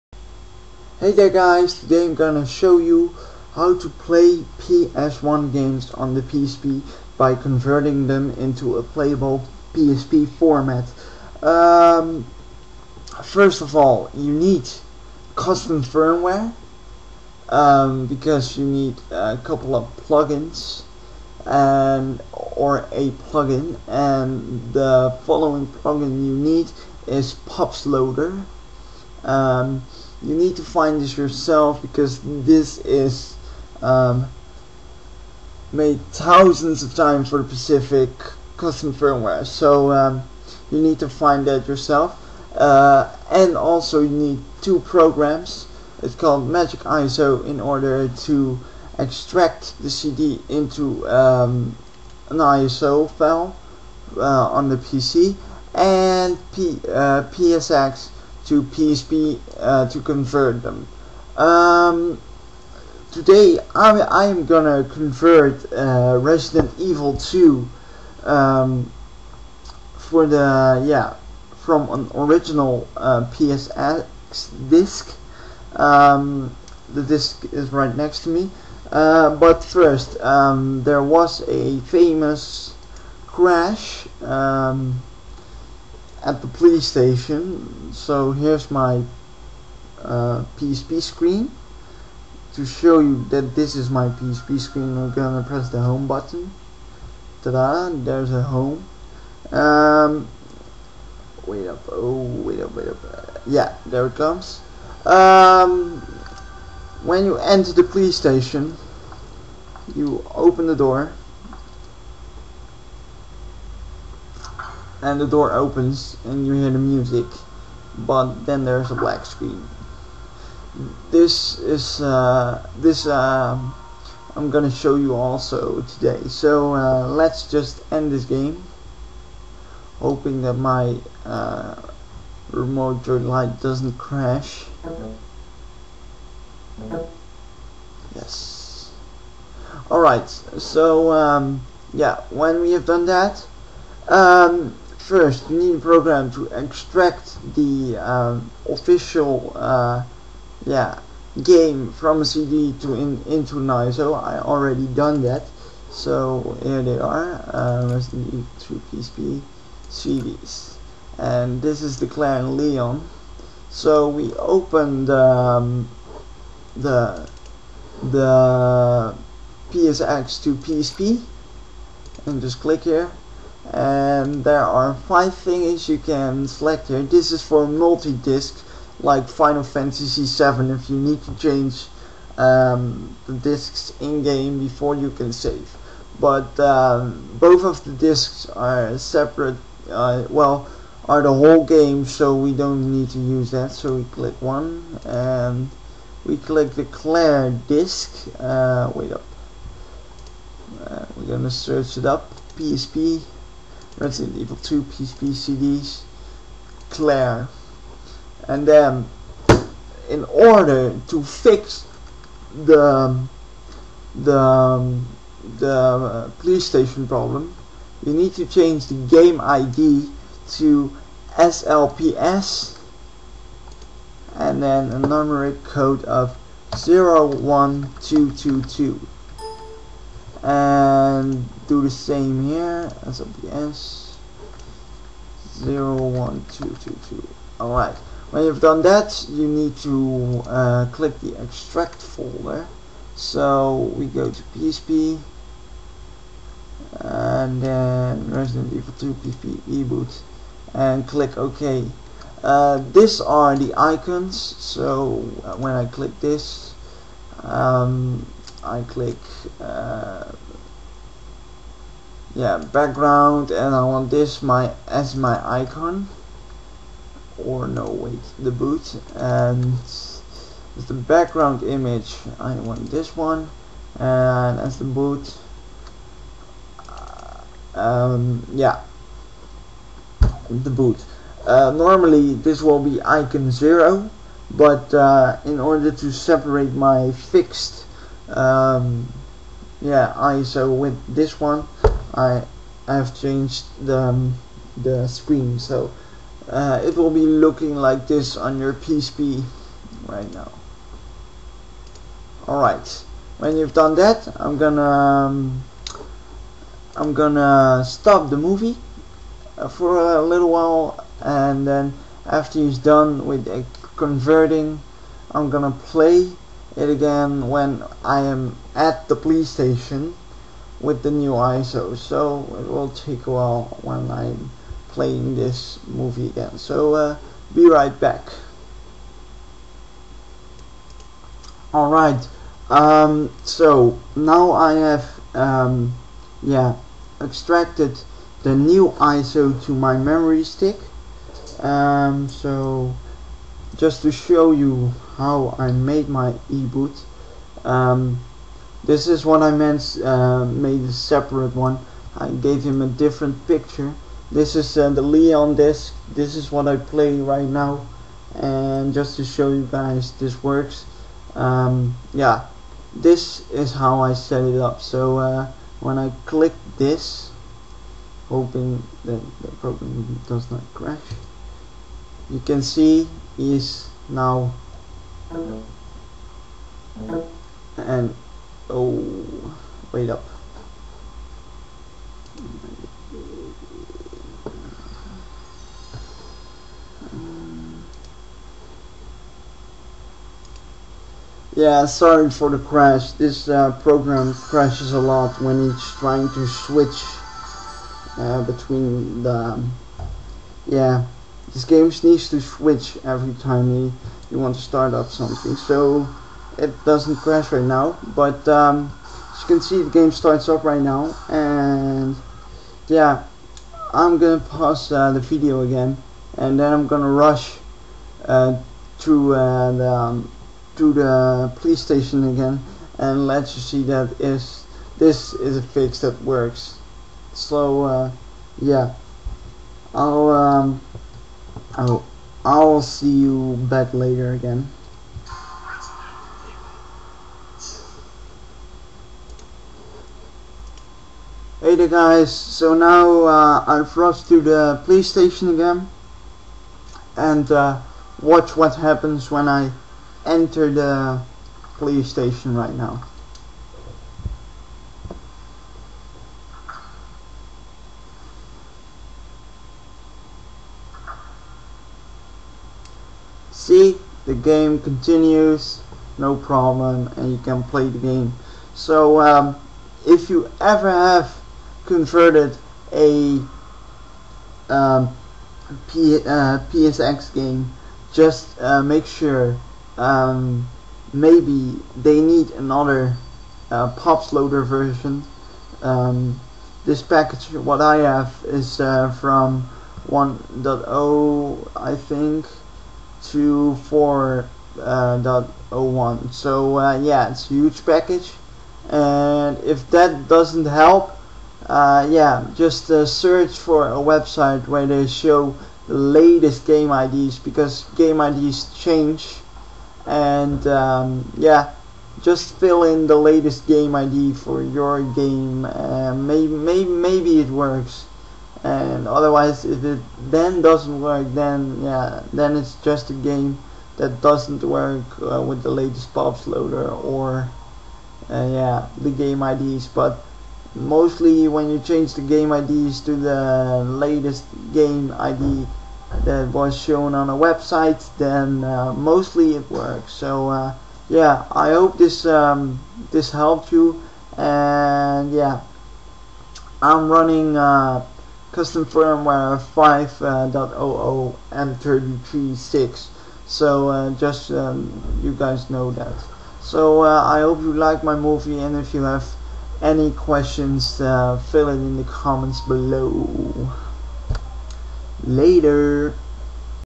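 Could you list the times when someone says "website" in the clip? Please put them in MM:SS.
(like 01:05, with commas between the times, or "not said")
08:23, 08:57.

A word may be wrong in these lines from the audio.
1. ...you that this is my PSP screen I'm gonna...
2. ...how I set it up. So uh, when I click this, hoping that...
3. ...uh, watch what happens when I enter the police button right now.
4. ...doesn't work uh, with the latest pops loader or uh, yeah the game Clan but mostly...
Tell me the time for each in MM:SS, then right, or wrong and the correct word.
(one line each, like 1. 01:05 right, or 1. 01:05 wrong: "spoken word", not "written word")
1. 01:32 right
2. 06:03 right
3. 07:27 wrong: "station", not "button"
4. 08:44 wrong: "IDs", not "Clan".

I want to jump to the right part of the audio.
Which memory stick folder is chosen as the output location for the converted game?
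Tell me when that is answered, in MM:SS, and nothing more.
04:08.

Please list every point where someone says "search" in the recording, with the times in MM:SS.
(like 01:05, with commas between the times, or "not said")
03:21, 08:23.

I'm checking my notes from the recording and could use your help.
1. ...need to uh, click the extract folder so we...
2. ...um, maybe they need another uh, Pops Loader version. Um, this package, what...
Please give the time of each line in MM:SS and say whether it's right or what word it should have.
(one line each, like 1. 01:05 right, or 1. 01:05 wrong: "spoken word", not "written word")
1. 03:59 right
2. 07:59 right.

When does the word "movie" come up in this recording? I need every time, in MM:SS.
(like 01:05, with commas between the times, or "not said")
05:08, 05:25, 09:18.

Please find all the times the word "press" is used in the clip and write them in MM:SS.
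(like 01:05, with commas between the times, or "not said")
01:35.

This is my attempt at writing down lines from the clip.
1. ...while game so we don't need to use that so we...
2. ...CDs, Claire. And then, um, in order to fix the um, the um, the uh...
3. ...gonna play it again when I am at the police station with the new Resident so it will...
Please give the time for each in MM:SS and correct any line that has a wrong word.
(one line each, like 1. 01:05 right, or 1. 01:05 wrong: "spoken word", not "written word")
1. 03:11 wrong: "whole", not "while"
2. 03:25 right
3. 05:15 wrong: "ISO", not "Resident".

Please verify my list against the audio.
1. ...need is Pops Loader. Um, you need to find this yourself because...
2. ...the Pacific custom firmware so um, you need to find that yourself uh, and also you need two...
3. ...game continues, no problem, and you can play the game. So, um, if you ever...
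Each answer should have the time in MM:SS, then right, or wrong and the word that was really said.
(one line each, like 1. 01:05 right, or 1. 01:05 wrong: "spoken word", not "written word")
1. 00:26 right
2. 00:37 right
3. 07:44 right.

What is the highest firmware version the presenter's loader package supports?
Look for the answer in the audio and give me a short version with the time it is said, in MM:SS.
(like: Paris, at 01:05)
4.01, at 08:13.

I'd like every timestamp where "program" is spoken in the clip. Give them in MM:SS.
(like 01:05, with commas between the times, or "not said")
00:44, 02:25, 06:09, 06:33.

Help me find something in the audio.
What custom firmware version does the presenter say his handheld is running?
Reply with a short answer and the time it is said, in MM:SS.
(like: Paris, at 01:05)
5.00 M33-6, at 09:09.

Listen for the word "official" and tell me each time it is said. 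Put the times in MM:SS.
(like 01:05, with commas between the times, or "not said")
02:28.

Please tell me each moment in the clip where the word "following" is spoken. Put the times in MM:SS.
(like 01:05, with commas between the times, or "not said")
00:25.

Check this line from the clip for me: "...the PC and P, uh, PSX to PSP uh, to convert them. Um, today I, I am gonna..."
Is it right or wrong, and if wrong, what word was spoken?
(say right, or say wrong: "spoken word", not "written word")
right.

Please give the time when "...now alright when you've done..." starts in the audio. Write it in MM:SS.
05:00.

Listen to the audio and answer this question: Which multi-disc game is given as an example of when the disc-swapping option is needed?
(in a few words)
Final Fantasy 7.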